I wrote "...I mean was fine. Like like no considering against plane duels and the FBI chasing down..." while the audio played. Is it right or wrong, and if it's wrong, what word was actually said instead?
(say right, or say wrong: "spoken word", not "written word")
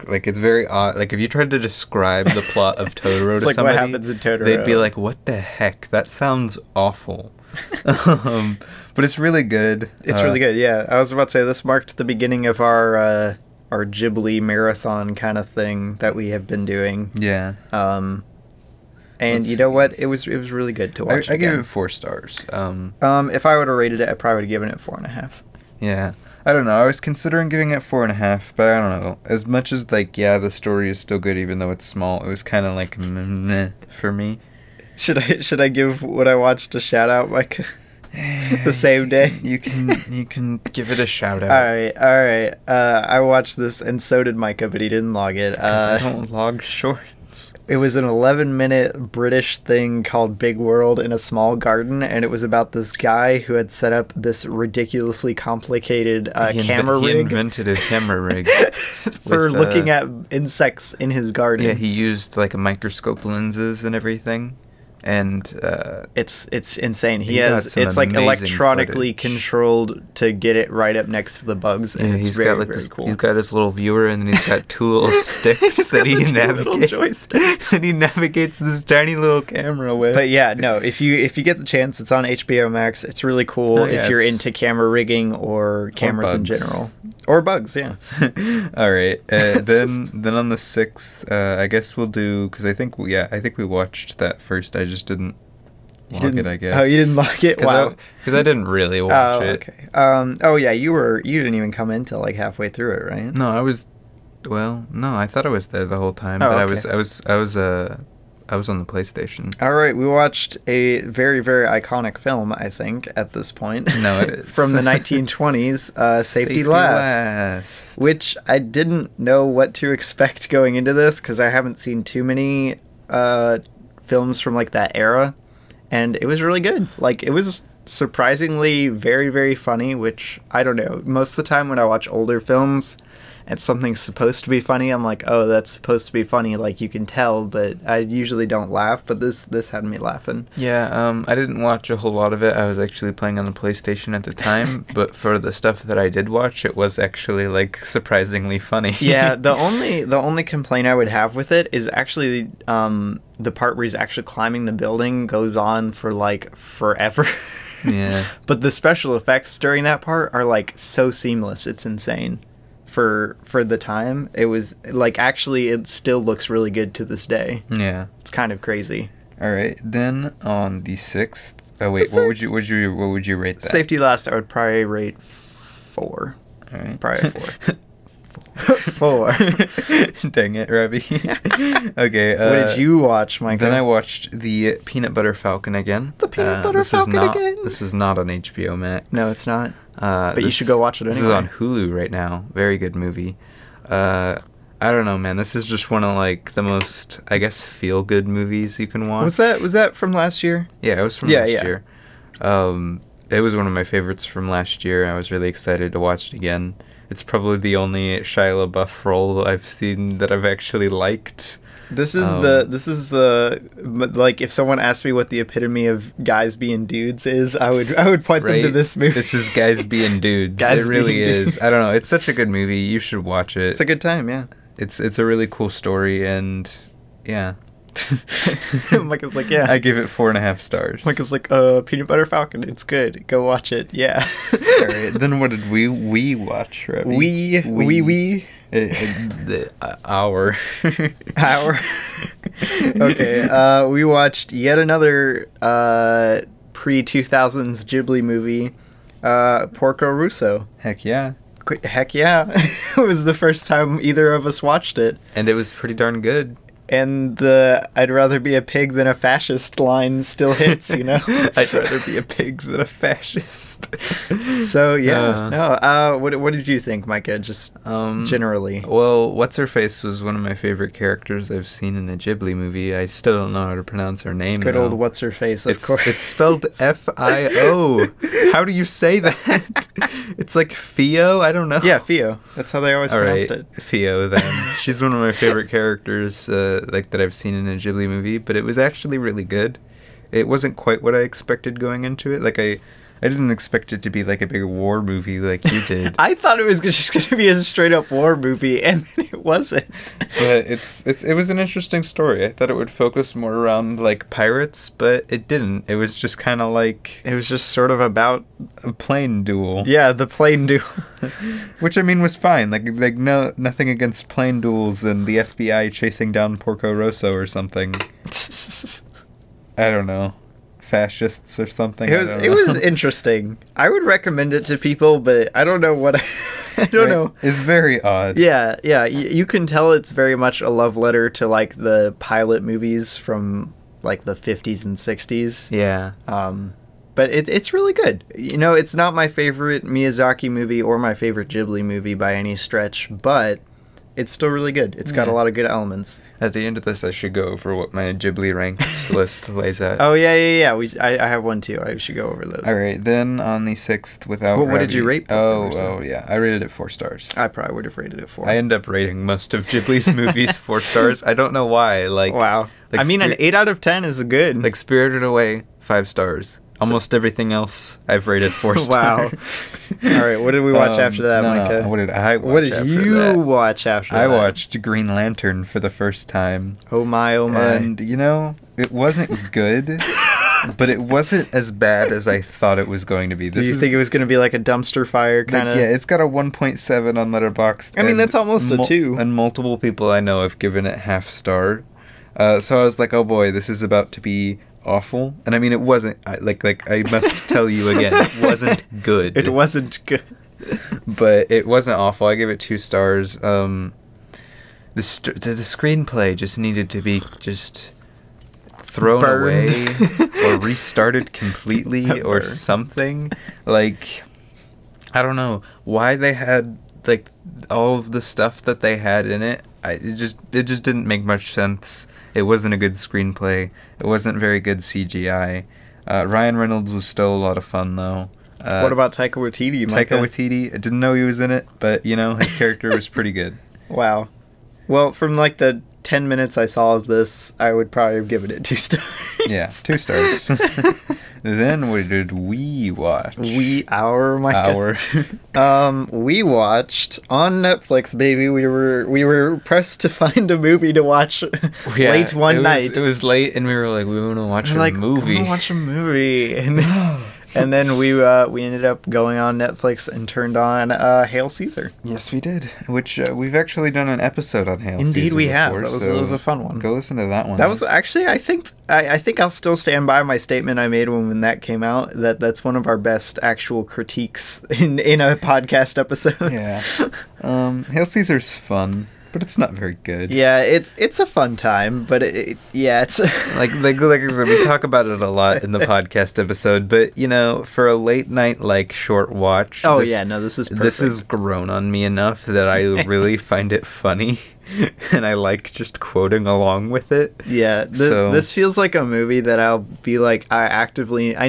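wrong: "nothing", not "considering".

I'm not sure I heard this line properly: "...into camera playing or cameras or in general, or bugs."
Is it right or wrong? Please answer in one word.
wrong.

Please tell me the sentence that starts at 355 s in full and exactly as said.
Oh, oh yeah, I rated it four stars.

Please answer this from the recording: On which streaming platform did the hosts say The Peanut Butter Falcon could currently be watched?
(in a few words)
Hulu.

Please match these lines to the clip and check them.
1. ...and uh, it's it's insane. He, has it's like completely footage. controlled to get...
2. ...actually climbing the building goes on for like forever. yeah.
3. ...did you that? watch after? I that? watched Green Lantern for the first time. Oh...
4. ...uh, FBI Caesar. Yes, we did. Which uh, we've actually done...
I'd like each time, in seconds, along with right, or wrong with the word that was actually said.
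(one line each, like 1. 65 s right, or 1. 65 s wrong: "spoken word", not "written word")
1. 65 s wrong: "electronically", not "completely"
2. 153 s right
3. 372 s right
4. 460 s wrong: "Hail", not "FBI".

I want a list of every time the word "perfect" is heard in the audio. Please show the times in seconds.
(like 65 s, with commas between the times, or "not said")
490 s.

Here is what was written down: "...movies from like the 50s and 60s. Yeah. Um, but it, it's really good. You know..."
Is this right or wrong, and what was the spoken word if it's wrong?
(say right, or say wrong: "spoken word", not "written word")
right.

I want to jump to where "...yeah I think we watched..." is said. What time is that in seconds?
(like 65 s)
92 s.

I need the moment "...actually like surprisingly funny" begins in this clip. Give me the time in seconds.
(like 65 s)
146 s.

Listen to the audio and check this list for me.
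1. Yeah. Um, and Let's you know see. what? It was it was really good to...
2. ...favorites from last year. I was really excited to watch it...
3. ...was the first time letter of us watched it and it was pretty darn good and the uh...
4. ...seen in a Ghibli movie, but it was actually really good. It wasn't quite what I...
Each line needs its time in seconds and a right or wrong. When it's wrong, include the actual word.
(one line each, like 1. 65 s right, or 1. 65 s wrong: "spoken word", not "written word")
1. 17 s right
2. 203 s right
3. 253 s wrong: "either", not "letter"
4. 287 s right.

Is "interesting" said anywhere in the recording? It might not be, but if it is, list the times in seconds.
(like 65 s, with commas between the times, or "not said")
301 s, 322 s.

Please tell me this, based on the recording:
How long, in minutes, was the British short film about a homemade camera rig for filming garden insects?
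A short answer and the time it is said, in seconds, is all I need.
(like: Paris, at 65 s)
11, at 48 s.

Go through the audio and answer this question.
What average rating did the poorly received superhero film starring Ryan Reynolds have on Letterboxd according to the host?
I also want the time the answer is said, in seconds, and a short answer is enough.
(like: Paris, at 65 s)
1.7, at 386 s.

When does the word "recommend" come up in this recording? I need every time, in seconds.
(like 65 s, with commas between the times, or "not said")
324 s.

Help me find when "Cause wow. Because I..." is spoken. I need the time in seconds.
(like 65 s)
97 s.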